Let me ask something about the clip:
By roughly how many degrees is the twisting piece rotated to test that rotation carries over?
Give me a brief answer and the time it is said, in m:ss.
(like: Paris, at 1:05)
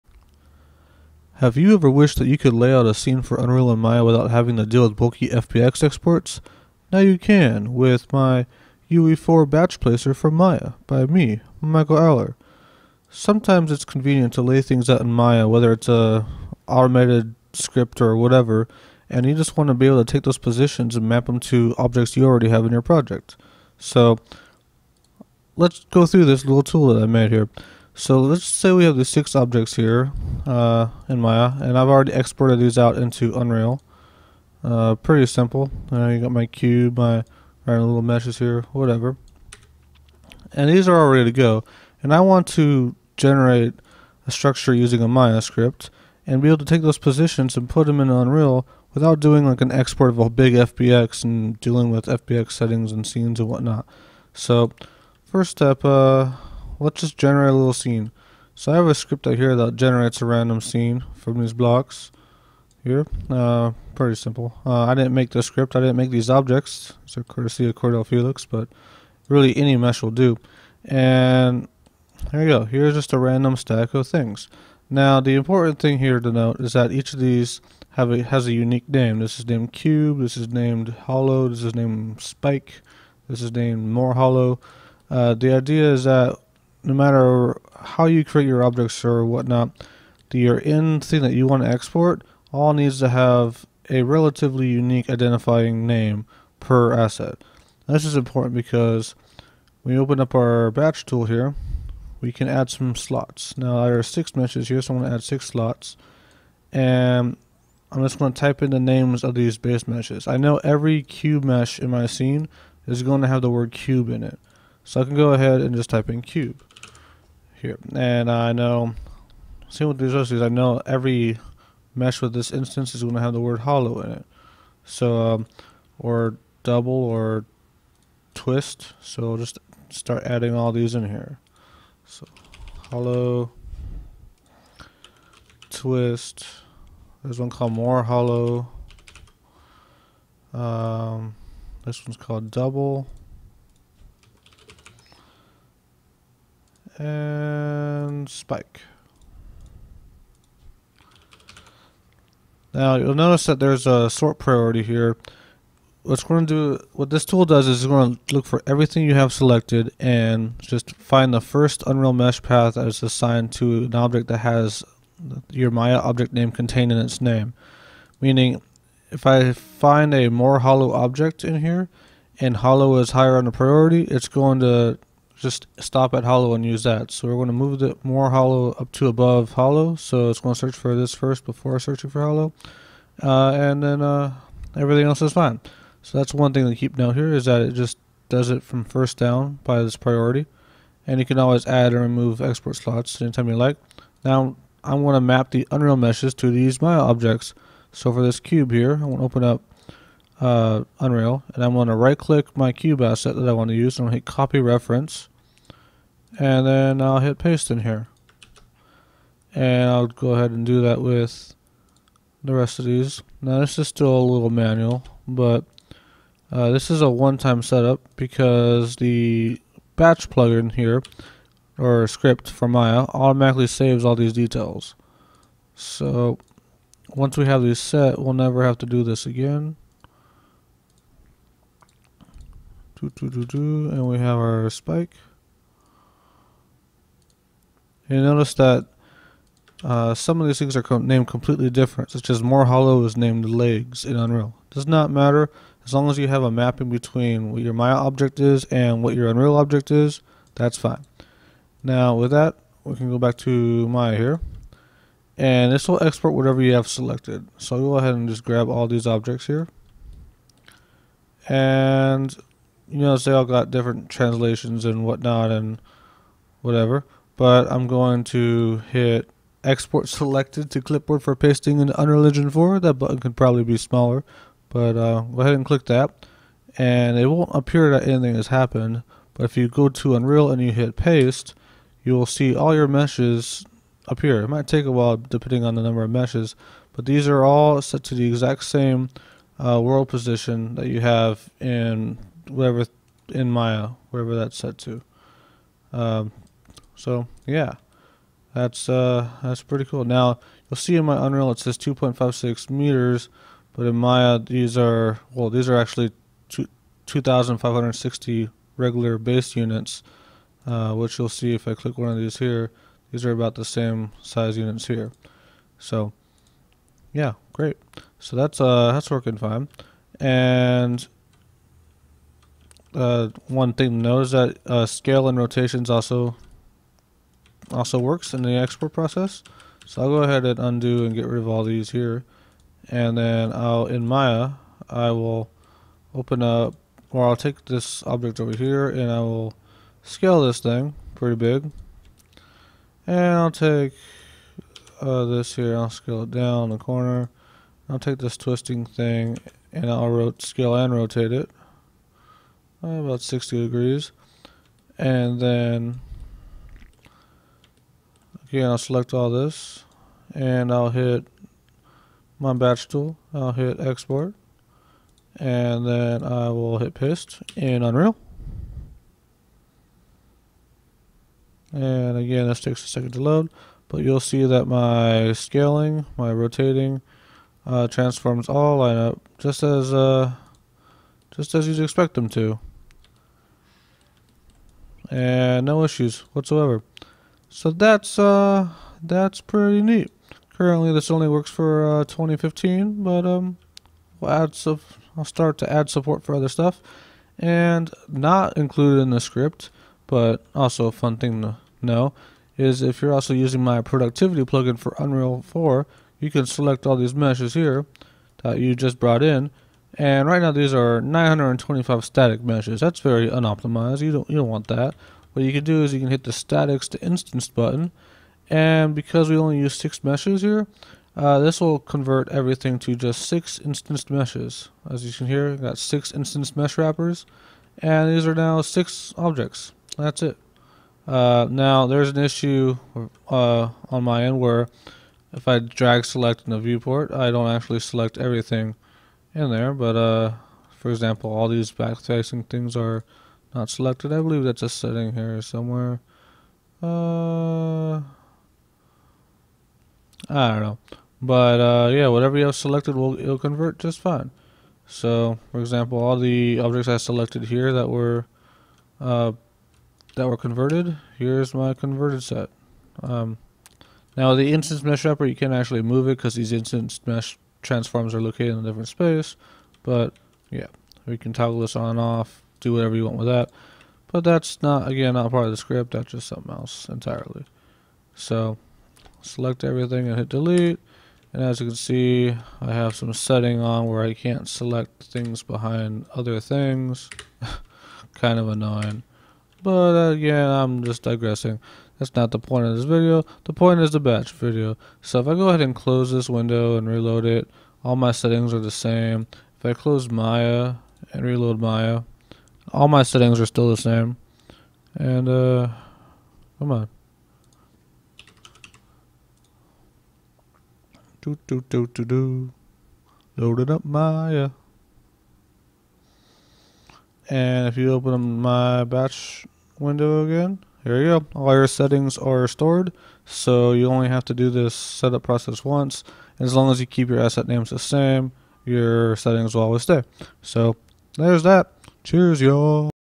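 60, at 5:53.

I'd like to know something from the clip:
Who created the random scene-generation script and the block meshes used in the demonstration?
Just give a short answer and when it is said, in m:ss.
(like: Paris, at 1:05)
Cordell Felix, at 1:07.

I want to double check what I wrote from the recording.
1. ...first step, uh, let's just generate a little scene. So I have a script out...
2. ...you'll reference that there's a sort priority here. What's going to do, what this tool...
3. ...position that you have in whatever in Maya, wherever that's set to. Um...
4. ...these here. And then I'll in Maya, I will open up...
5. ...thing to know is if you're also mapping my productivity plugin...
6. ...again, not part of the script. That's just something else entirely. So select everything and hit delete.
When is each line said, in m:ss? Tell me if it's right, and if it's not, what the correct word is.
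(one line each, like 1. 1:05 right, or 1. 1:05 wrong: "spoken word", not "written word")
1. 0:55 right
2. 2:32 wrong: "notice", not "reference"
3. 4:50 right
4. 5:31 right
5. 6:41 wrong: "using", not "mapping"
6. 7:54 right.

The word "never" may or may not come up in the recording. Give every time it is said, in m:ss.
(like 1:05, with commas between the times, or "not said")
3:48.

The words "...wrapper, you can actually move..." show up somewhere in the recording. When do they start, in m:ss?
7:45.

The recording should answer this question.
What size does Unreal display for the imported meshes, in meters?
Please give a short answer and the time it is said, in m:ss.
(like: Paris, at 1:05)
2.56 meters, at 5:01.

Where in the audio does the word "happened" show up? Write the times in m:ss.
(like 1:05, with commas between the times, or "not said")
4:38.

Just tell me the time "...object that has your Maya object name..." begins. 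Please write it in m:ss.
2:43.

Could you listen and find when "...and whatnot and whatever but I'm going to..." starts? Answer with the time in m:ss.
4:24.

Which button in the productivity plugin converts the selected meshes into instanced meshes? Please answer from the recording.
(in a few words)
Statics to instance.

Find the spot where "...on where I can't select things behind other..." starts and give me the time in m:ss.
8:03.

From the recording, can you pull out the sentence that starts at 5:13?
These are about the same size units here.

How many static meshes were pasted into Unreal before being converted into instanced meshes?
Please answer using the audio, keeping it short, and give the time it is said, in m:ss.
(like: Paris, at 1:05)
925, at 6:51.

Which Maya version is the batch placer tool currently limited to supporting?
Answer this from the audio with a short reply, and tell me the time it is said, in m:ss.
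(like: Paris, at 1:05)
2015, at 6:32.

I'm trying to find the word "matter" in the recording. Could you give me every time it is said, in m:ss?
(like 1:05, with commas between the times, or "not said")
1:26, 4:05.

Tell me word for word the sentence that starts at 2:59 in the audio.
So it's going to search for this first before searching for hollow.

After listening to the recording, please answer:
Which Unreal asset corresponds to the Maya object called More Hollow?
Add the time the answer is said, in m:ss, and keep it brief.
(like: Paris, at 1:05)
Legs, at 4:03.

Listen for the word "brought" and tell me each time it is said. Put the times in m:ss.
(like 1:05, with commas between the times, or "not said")
6:48.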